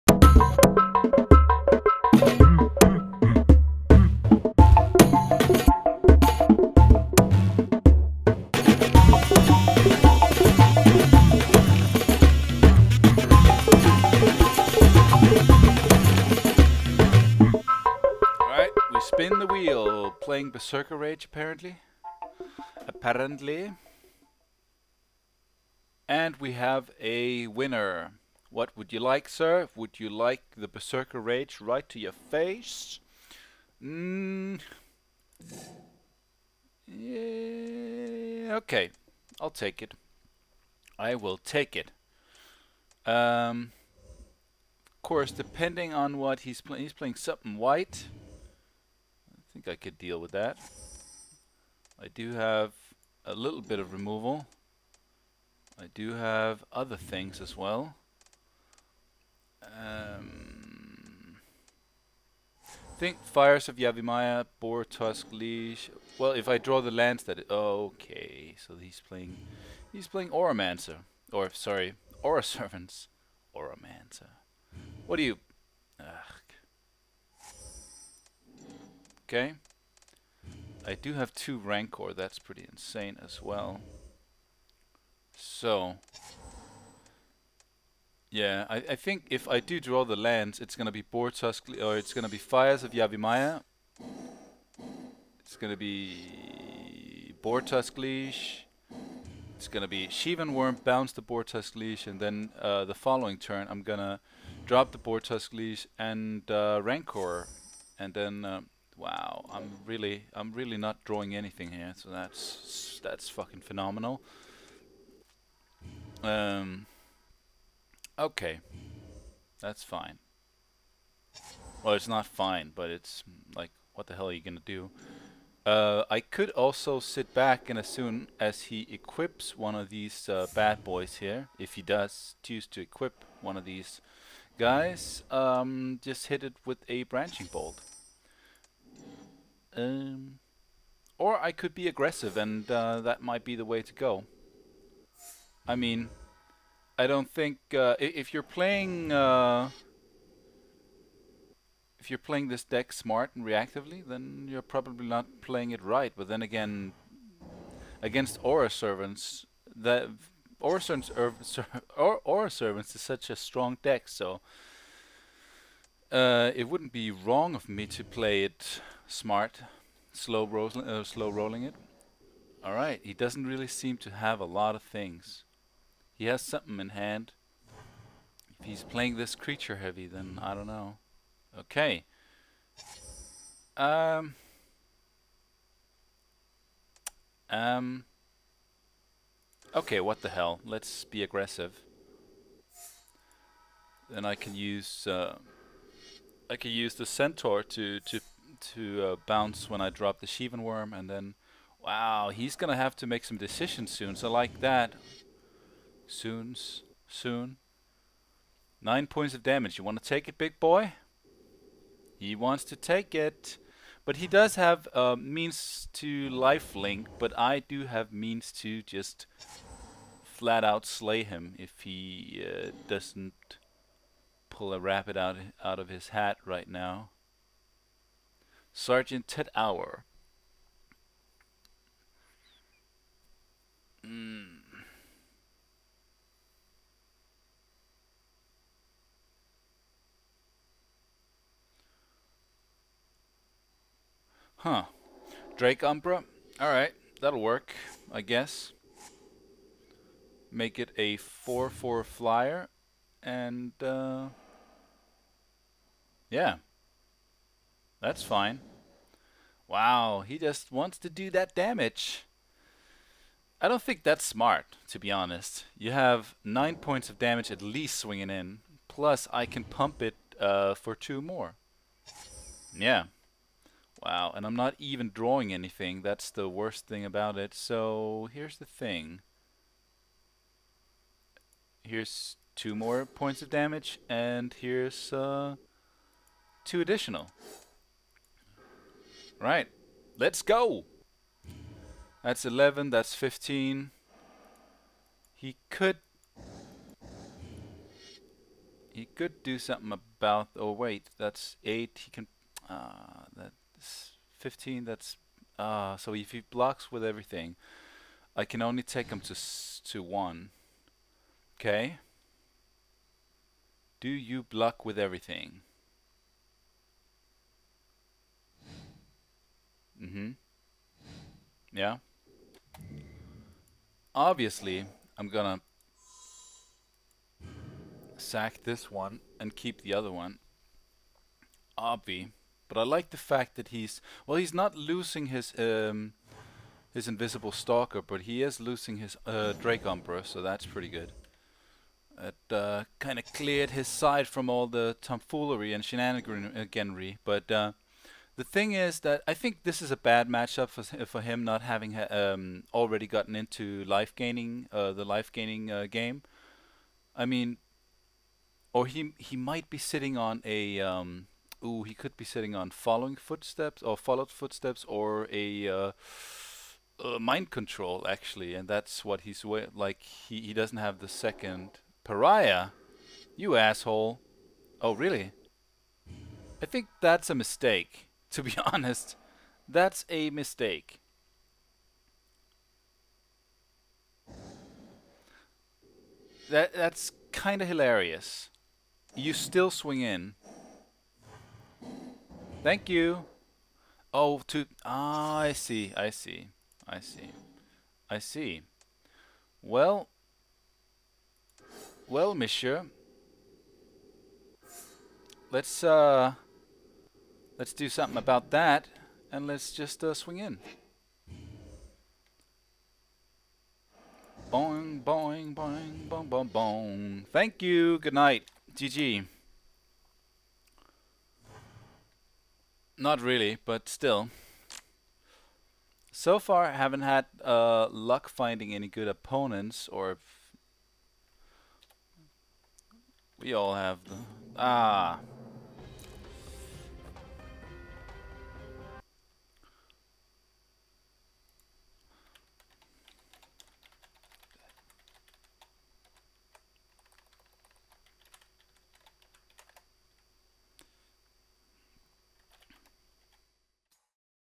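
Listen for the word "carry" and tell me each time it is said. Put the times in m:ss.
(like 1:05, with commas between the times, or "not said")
not said.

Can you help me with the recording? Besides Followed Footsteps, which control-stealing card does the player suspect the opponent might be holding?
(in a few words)
Mind Control.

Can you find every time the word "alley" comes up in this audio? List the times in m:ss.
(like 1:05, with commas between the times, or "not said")
not said.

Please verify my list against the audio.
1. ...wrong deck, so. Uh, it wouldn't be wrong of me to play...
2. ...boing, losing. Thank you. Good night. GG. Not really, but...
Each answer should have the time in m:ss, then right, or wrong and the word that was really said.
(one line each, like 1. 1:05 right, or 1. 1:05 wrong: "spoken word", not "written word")
1. 2:43 wrong: "strong", not "wrong"
2. 6:56 wrong: "boing", not "losing".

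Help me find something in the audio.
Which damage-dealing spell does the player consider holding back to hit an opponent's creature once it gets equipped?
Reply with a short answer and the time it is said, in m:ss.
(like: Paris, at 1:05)
Branching Bolt, at 2:17.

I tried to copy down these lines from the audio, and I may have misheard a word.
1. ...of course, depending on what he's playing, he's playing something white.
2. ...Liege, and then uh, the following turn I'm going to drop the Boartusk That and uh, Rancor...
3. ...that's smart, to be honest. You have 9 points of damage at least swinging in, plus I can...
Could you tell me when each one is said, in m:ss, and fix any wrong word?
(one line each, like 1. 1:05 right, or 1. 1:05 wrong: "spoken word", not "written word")
1. 0:44 right
2. 1:41 wrong: "Liege", not "That"
3. 4:24 right.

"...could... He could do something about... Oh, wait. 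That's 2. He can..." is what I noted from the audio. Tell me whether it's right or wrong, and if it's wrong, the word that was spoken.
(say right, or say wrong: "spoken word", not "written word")
wrong: "8", not "2".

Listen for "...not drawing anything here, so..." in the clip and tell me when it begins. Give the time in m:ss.
1:50.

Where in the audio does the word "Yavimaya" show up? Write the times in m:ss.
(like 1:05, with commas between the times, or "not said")
1:03, 1:32.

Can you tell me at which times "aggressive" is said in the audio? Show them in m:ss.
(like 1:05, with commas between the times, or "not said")
2:21, 3:11.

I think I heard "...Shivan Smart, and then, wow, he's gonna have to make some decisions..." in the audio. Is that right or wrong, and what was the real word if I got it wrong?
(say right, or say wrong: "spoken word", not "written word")
wrong: "Wurm", not "Smart".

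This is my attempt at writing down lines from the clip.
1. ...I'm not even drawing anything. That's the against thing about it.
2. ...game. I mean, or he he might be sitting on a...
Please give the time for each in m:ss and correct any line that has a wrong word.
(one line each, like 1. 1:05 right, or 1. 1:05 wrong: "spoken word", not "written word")
1. 4:34 wrong: "worst", not "against"
2. 5:55 right.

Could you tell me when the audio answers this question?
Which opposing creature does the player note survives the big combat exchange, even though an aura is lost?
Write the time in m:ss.
5:37.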